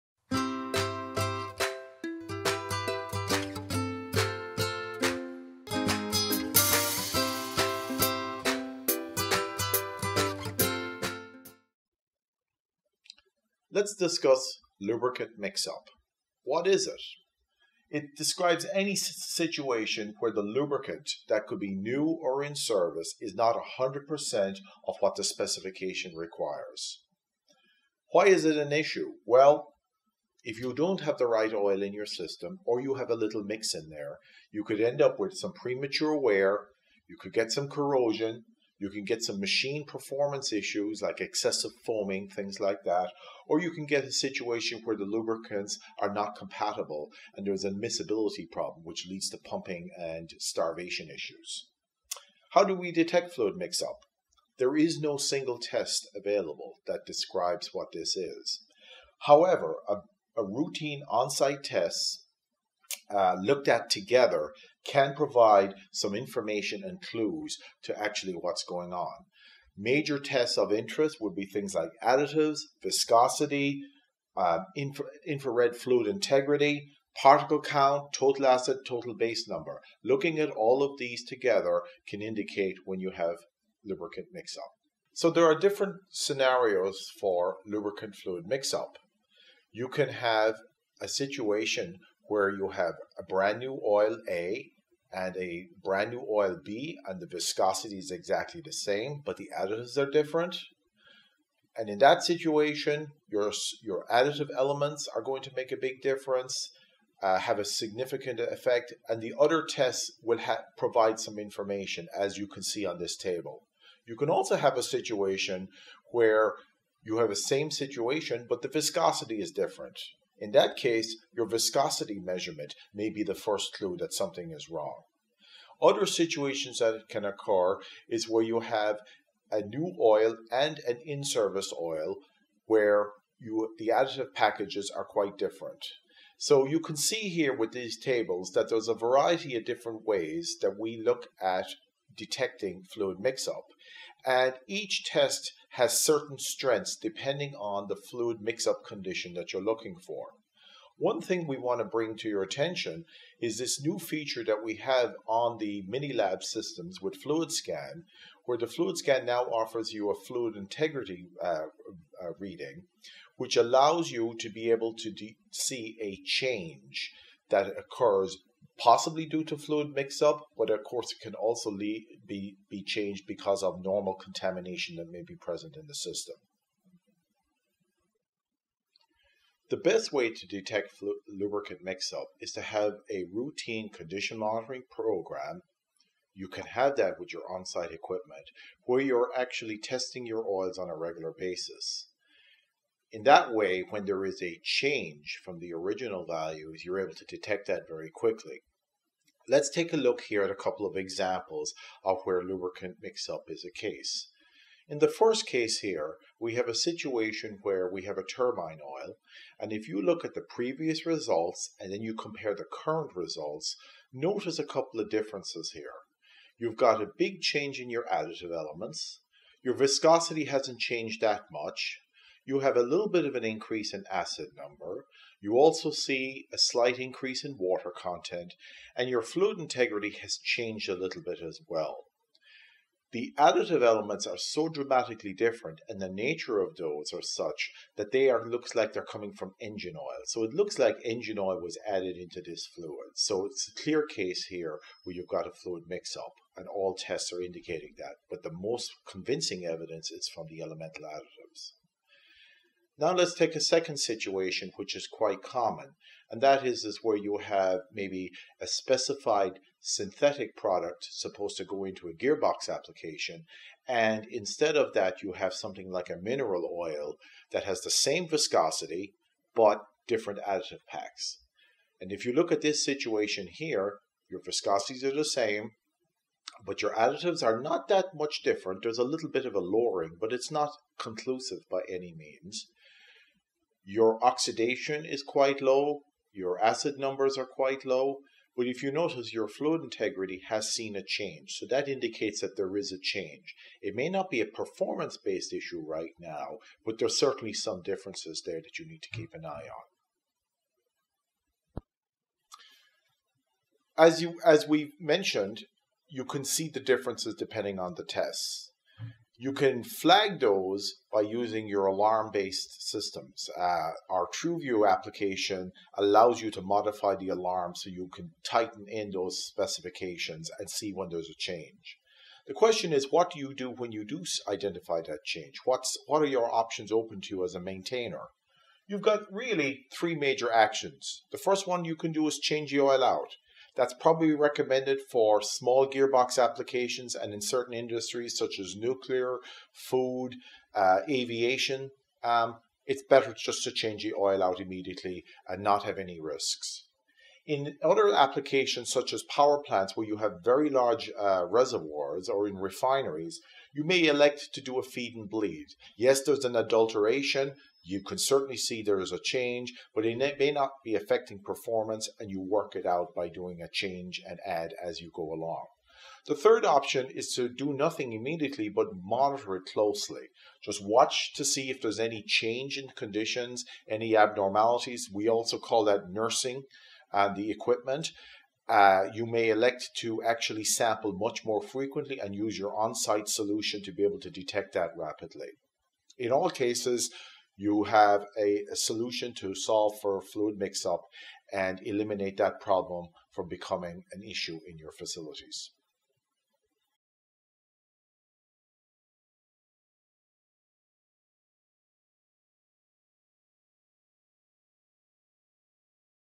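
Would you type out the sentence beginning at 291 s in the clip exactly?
So that indicates that there is a change.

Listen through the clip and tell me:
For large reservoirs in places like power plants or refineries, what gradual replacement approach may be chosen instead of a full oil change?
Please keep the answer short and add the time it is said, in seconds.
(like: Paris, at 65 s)
feed and bleed, at 354 s.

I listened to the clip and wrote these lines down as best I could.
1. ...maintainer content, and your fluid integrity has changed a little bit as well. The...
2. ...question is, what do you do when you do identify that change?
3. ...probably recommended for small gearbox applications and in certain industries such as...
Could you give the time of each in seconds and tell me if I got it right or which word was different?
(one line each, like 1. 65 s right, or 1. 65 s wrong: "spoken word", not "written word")
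1. 227 s wrong: "water", not "maintainer"
2. 322 s right
3. 333 s right.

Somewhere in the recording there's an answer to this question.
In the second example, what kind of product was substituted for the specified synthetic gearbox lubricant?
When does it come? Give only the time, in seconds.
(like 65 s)
266 s.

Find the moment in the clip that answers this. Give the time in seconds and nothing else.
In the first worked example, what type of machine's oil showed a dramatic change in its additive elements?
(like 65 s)
208 s.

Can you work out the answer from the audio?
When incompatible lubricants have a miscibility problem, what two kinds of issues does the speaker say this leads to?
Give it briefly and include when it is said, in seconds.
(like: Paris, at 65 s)
pumping and starvation, at 49 s.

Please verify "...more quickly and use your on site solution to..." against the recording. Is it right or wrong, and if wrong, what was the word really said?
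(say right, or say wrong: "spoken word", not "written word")
wrong: "frequently", not "quickly".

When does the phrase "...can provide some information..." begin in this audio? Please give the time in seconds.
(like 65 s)
64 s.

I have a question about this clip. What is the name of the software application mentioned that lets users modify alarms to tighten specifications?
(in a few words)
TruVu.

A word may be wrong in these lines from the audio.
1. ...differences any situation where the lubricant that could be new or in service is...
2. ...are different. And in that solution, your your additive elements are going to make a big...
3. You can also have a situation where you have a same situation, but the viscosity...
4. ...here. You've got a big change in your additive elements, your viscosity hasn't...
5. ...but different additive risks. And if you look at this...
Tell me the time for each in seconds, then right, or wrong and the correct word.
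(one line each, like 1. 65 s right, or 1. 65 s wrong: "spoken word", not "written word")
1. 18 s wrong: "describes", not "differences"
2. 99 s wrong: "situation", not "solution"
3. 114 s right
4. 215 s right
5. 269 s wrong: "packs", not "risks".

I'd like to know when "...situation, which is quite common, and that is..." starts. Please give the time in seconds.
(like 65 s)
253 s.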